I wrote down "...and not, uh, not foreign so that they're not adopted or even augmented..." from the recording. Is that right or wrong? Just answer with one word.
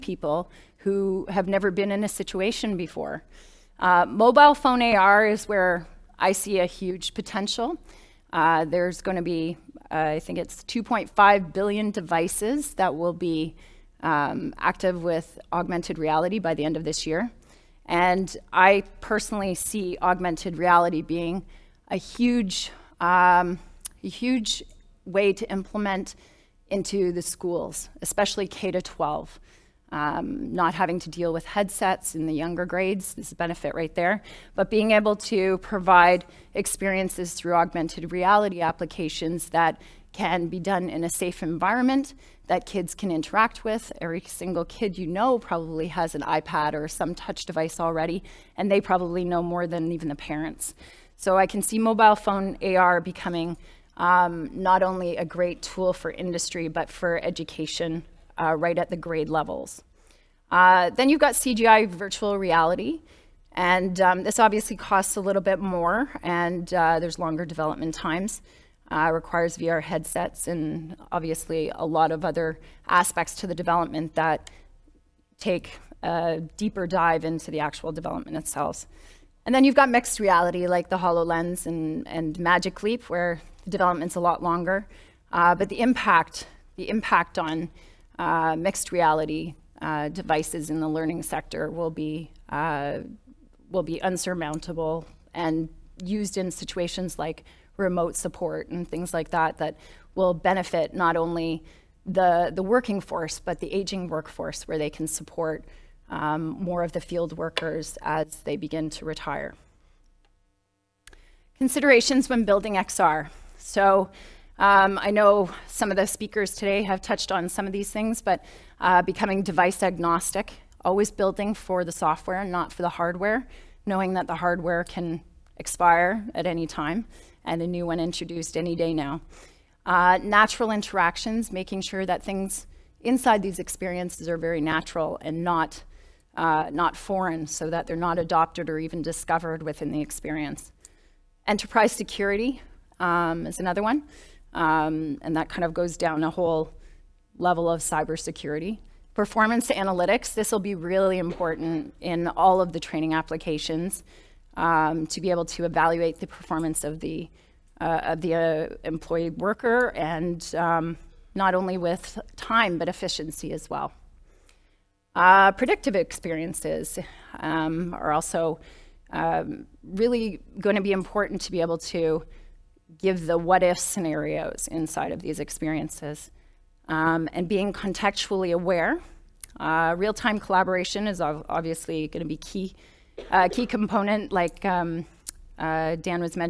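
wrong.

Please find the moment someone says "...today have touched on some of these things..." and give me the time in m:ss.
1:56.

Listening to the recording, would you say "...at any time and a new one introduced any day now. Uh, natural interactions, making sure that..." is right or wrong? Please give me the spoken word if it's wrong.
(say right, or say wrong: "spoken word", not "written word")
right.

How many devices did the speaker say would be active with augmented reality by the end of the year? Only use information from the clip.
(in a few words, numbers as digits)
2.5 billion.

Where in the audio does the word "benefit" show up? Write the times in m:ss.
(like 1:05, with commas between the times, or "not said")
0:33, 1:40.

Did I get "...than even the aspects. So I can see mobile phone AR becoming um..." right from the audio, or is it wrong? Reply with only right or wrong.
wrong.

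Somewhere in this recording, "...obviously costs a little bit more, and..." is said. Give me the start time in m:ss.
1:04.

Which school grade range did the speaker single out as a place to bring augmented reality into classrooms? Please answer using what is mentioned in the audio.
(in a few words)
K to 12.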